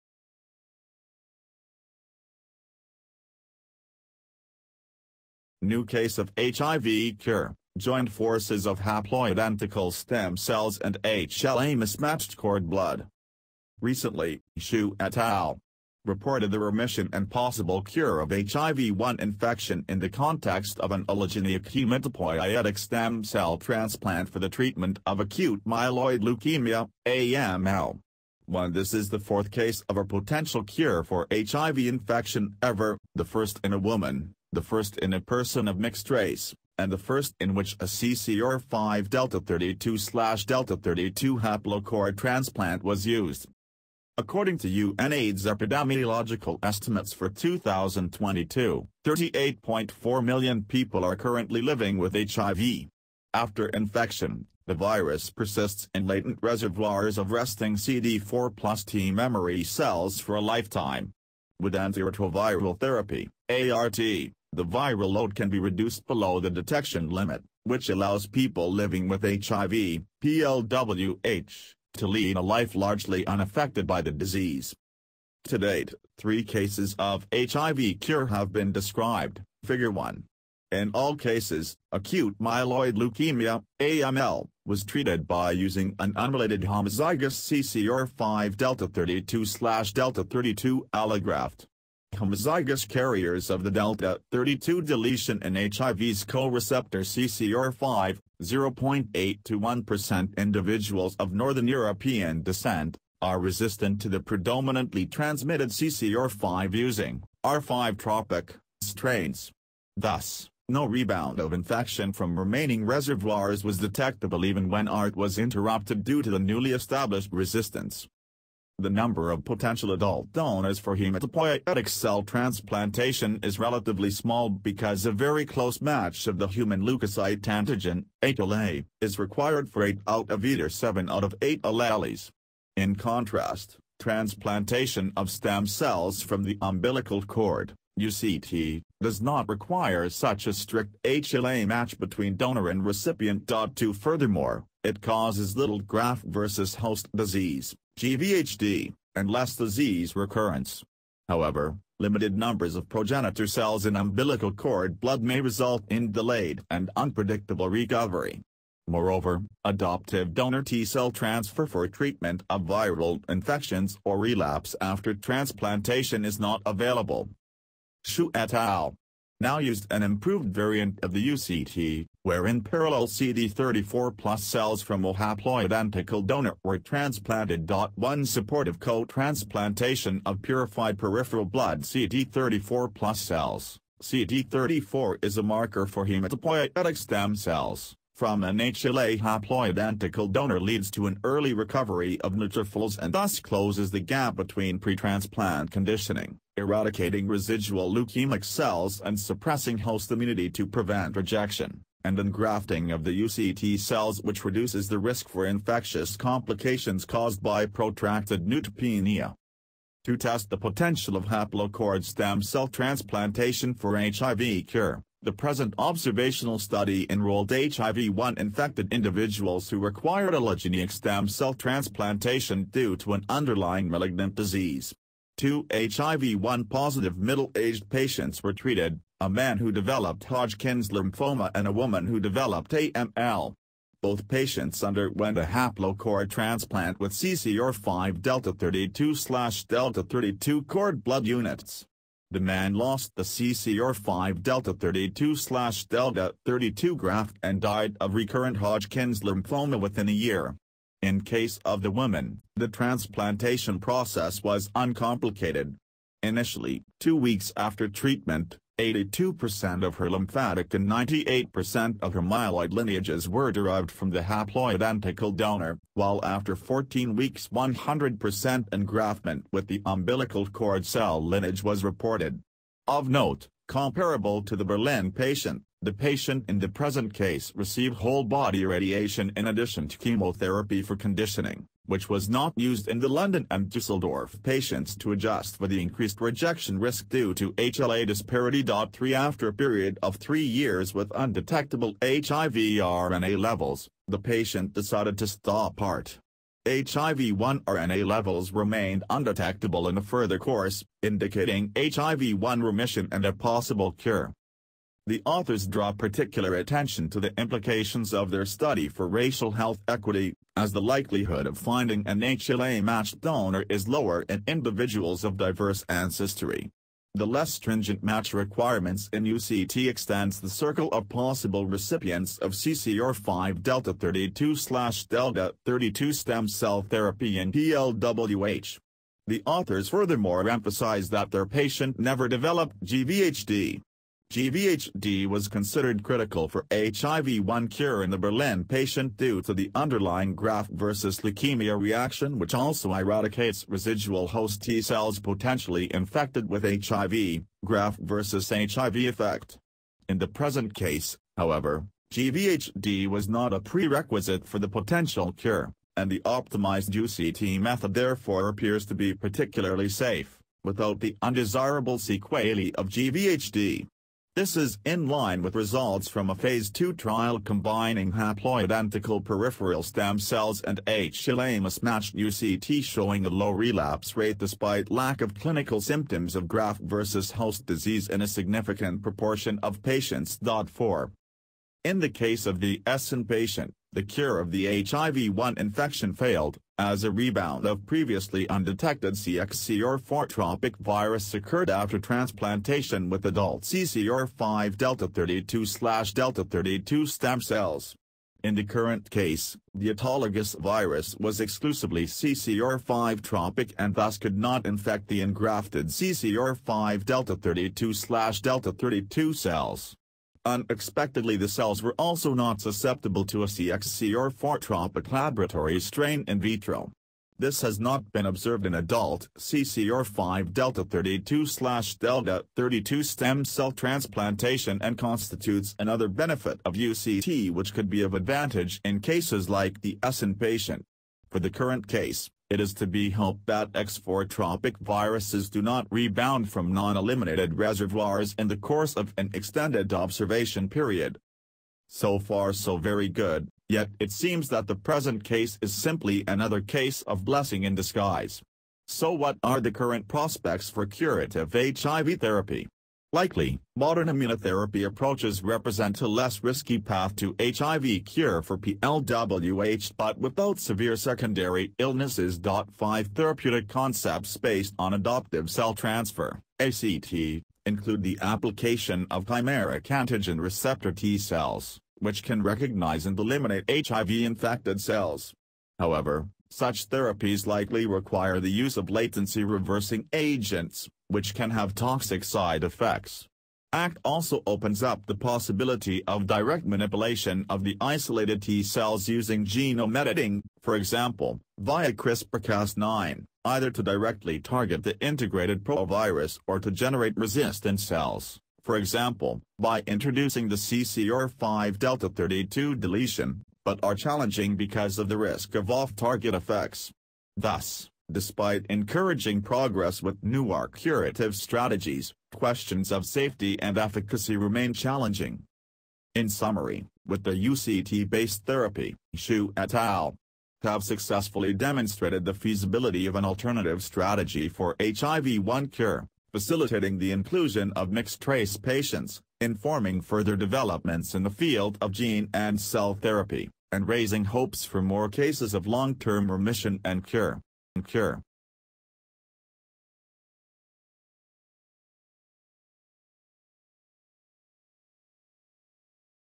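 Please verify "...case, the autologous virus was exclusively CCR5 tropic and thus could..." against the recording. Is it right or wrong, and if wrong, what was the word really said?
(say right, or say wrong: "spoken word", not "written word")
right.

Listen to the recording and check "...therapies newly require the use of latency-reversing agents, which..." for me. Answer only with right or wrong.
wrong.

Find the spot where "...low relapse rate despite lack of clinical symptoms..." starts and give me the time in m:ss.
6:13.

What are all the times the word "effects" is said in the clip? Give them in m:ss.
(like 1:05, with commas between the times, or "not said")
5:48, 8:02, 8:26.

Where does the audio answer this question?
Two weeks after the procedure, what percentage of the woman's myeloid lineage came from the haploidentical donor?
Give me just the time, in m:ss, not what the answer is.
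4:20.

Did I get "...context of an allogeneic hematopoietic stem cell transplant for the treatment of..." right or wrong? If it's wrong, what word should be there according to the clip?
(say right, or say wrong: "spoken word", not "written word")
right.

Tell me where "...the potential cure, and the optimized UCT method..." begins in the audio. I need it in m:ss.
5:54.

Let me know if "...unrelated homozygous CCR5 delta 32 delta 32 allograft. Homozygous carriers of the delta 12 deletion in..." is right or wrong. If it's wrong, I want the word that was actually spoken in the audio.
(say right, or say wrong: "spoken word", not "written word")
wrong: "32", not "12".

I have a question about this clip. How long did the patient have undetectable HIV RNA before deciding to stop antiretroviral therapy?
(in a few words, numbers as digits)
3 years.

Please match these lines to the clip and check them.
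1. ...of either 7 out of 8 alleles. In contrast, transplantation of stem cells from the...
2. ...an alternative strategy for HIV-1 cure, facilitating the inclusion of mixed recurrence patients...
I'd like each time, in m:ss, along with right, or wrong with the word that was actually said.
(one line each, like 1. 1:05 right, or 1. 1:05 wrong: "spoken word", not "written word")
1. 2:10 right
2. 8:43 wrong: "trace", not "recurrence".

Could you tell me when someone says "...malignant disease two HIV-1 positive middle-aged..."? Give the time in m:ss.
3:43.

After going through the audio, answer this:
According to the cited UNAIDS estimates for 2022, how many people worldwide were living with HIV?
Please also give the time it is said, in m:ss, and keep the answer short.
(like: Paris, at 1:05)
38.4 million, at 0:49.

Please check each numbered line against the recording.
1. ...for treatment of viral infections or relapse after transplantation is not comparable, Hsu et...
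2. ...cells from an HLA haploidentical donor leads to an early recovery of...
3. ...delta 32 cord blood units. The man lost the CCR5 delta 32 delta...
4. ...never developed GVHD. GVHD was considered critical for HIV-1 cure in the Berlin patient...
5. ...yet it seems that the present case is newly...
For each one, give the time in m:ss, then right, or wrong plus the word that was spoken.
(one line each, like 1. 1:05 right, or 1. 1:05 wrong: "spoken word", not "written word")
1. 2:41 wrong: "available", not "comparable"
2. 3:07 right
3. 3:59 right
4. 5:31 right
5. 7:23 wrong: "simply", not "newly".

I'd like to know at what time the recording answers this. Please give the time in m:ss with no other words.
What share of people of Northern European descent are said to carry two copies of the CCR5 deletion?
1:38.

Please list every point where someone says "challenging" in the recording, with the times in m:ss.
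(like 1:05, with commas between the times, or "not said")
8:23, 8:34.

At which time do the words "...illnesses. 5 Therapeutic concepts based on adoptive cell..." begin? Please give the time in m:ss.
7:41.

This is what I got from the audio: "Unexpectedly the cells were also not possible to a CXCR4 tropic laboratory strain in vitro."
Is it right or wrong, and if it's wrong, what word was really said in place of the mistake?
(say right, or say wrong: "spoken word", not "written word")
wrong: "susceptible", not "possible".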